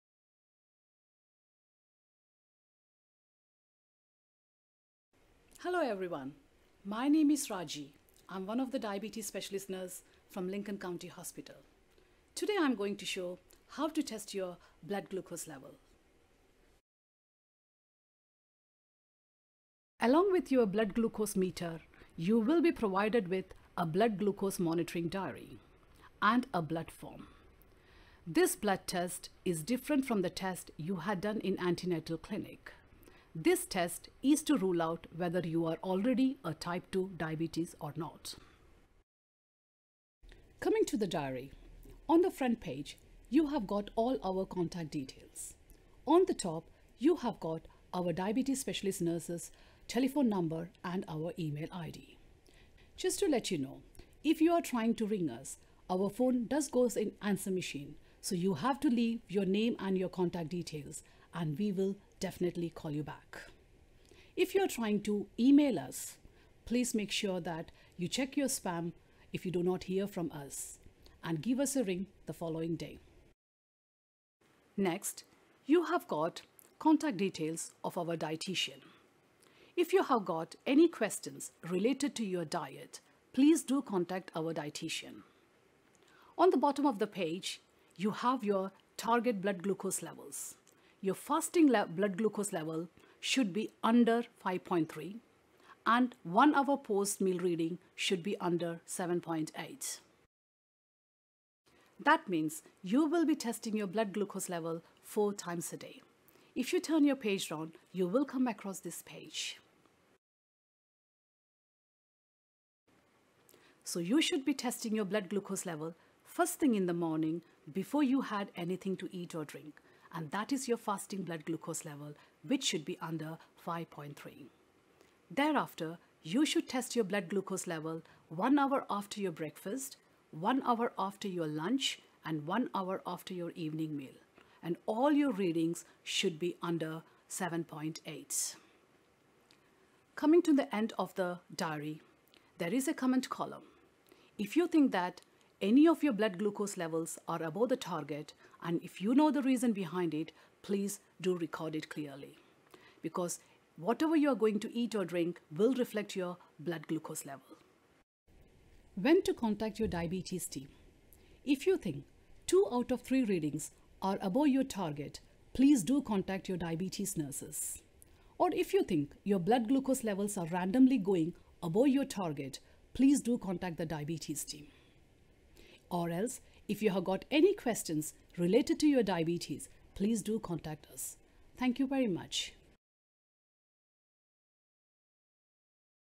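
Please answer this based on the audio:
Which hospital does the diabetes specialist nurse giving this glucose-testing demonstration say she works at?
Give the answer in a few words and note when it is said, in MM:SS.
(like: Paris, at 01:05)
Lincoln County Hospital, at 00:10.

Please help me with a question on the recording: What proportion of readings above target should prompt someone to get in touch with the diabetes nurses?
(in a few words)
2 out of 3.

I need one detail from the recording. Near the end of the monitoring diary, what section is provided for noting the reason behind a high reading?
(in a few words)
comment column.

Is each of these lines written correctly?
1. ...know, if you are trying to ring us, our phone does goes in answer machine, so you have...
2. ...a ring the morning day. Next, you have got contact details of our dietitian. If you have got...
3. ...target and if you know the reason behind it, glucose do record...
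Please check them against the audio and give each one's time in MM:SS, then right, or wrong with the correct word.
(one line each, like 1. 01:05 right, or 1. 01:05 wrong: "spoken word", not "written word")
1. 00:53 right
2. 01:11 wrong: "following", not "morning"
3. 02:27 wrong: "please", not "glucose".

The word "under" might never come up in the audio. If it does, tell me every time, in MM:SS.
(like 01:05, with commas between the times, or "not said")
01:33, 01:38, 02:03, 02:16.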